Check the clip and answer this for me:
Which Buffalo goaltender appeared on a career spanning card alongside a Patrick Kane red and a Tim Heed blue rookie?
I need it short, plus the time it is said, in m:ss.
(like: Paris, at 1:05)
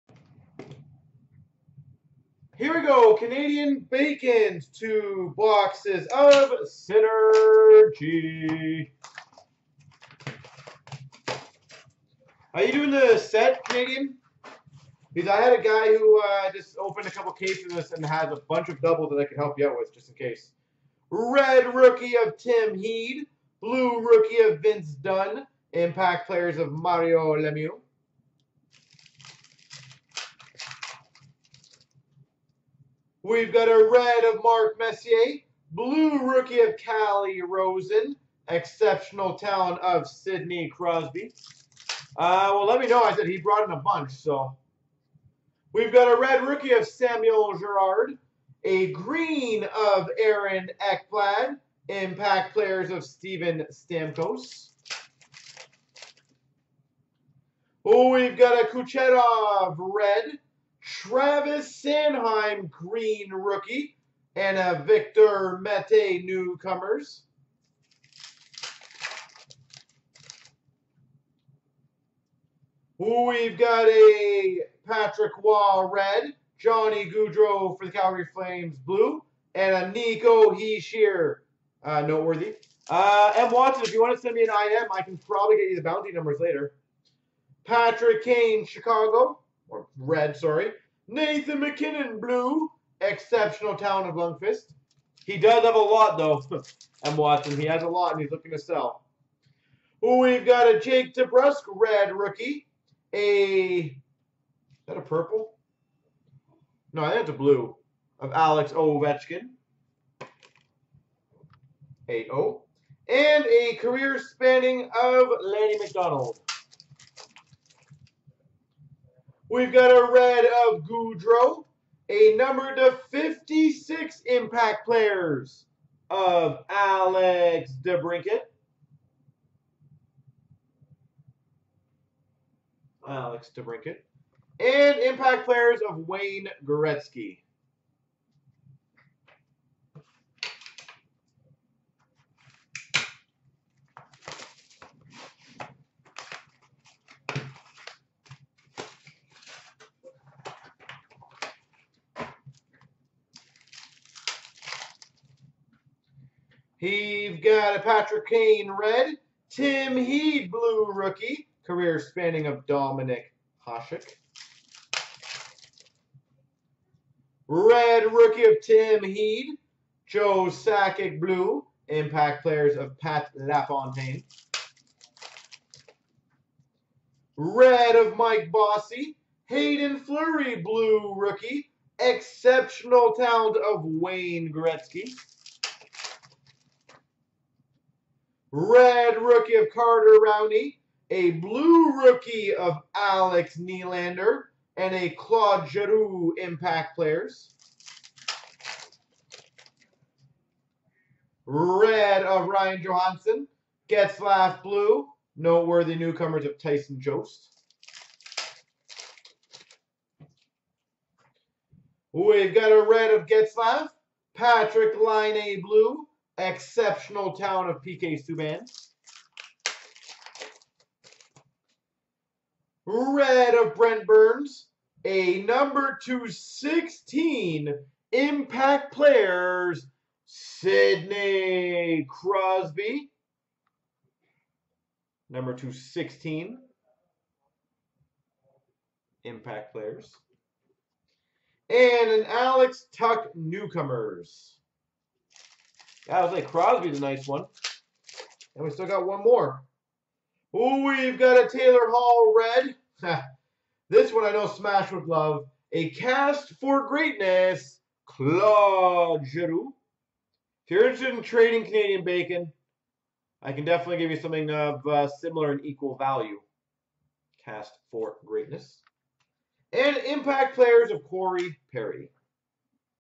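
Dominik Hasek, at 2:42.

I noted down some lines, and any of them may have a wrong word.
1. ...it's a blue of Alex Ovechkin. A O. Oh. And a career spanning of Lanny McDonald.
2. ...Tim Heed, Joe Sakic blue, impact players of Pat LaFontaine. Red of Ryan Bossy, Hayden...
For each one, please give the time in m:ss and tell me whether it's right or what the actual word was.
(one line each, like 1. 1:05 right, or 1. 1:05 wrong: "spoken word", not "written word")
1. 1:47 right
2. 2:48 wrong: "Mike", not "Ryan".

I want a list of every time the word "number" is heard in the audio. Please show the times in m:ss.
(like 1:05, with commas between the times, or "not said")
1:26, 2:02, 3:45, 3:55.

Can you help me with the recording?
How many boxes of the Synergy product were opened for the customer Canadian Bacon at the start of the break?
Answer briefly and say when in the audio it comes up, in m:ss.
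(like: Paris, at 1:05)
2, at 0:04.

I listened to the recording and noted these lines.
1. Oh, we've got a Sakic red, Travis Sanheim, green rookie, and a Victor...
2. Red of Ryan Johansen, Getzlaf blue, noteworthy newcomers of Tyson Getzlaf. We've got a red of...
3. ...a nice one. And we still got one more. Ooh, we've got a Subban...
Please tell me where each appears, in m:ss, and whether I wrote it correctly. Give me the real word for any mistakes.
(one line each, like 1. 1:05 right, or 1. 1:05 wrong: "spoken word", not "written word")
1. 0:57 wrong: "Kucherov", not "Sakic"
2. 3:21 wrong: "Jost", not "Getzlaf"
3. 4:06 wrong: "Taylor", not "Subban".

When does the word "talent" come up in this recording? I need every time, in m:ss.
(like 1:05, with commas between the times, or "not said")
0:39, 1:33, 3:03.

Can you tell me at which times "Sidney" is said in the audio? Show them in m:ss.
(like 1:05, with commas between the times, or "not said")
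0:40, 3:50.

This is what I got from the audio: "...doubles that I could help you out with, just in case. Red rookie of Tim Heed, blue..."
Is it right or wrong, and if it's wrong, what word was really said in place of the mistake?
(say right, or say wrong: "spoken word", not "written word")
right.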